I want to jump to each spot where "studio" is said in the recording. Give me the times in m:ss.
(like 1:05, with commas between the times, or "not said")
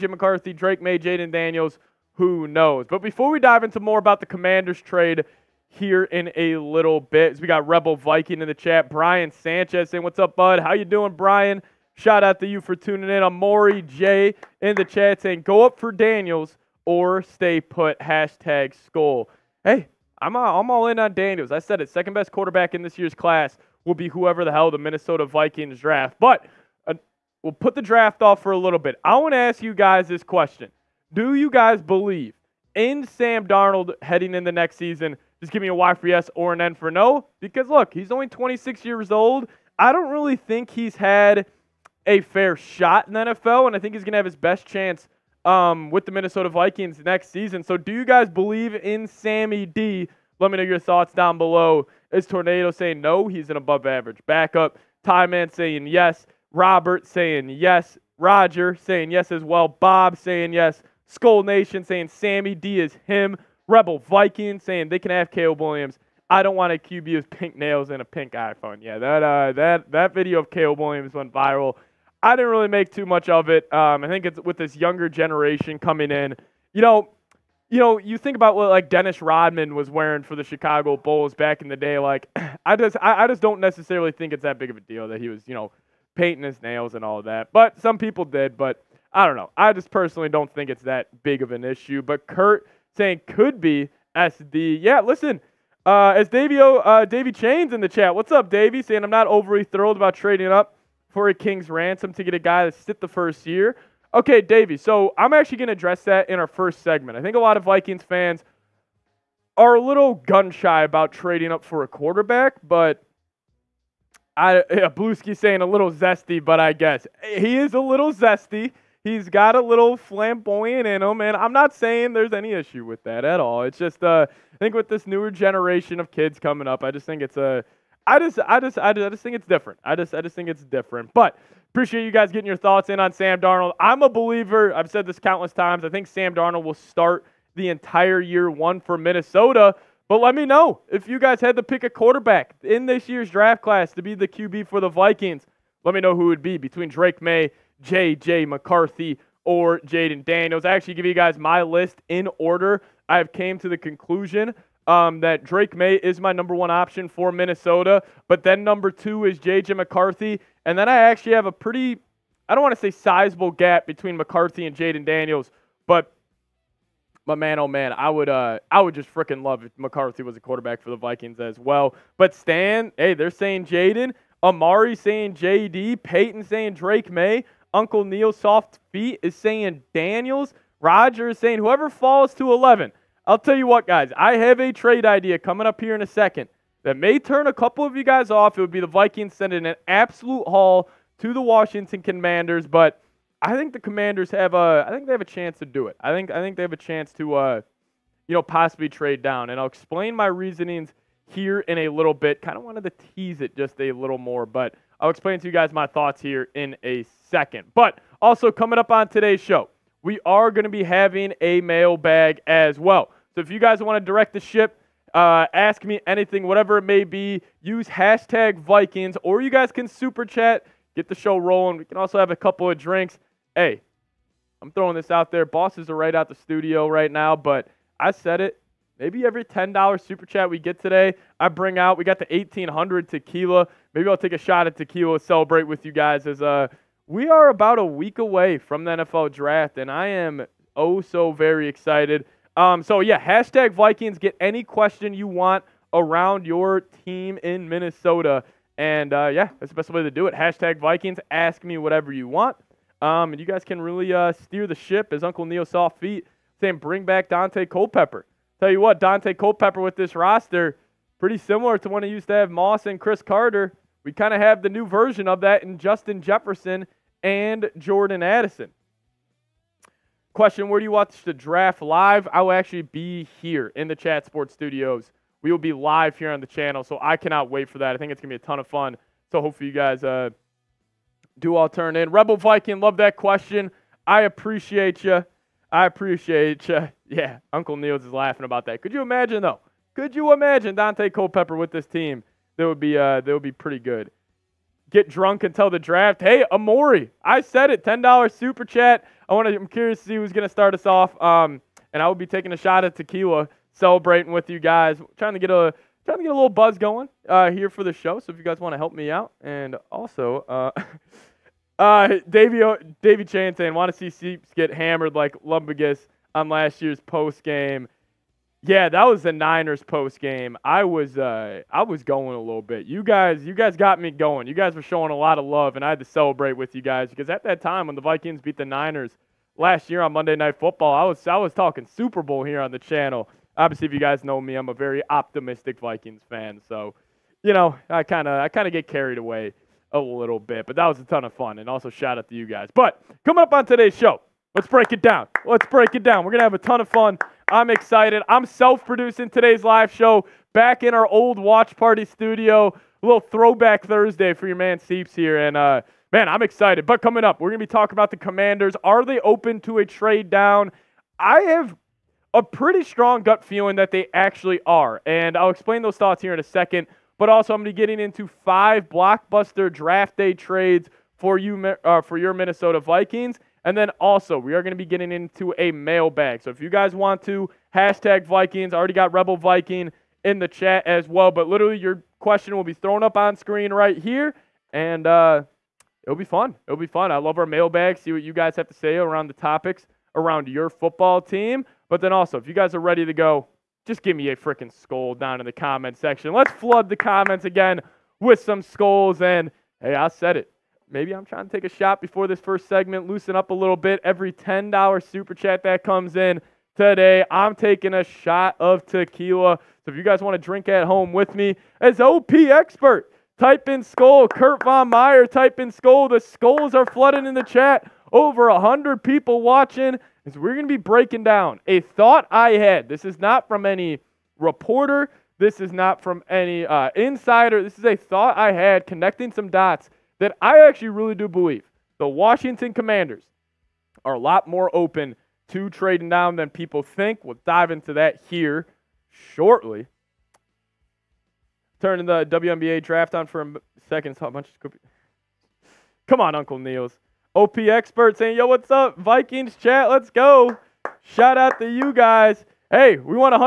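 3:46, 4:34, 5:52.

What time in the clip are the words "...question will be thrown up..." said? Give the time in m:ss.
6:22.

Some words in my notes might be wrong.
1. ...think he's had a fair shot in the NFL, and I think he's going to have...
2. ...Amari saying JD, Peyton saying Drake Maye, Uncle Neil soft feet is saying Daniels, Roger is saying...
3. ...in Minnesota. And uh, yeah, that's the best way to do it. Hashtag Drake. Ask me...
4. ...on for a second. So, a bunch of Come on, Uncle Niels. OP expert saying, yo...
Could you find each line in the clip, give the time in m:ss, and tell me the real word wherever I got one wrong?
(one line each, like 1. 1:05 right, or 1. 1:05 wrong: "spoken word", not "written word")
1. 0:40 right
2. 2:54 right
3. 4:07 wrong: "Vikings", not "Drake"
4. 7:23 right.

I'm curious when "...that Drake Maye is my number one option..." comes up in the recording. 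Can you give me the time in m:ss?
2:35.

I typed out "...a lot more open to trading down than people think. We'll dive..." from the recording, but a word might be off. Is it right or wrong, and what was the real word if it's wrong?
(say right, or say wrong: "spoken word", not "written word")
right.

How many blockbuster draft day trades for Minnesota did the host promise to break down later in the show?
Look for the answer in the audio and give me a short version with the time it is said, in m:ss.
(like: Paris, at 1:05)
5, at 6:08.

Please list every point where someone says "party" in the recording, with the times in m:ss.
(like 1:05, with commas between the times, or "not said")
5:51.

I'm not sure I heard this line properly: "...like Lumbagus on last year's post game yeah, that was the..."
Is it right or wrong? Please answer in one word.
right.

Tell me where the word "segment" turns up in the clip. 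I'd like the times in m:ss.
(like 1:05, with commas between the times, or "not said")
1:46, 6:42.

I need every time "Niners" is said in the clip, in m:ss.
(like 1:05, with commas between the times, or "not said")
5:19, 5:28.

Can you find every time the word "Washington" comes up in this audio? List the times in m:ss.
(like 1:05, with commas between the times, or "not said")
3:11, 7:12.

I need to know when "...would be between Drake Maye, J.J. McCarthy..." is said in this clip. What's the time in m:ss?
2:26.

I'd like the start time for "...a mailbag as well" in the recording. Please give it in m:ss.
3:31.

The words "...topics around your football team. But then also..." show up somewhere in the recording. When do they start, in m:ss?
6:29.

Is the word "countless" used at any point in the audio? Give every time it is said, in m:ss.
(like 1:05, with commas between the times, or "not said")
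2:15.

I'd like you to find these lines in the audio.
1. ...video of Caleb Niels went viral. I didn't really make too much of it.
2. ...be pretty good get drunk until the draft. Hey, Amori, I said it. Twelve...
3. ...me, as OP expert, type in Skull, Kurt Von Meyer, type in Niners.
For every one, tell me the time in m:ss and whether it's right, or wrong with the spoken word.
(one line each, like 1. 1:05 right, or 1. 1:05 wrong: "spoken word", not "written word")
1. 1:10 wrong: "Williams", not "Niels"
2. 4:53 wrong: "Ten", not "Twelve"
3. 6:51 wrong: "Skull", not "Niners".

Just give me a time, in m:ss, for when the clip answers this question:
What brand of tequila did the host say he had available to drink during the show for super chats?
3:52.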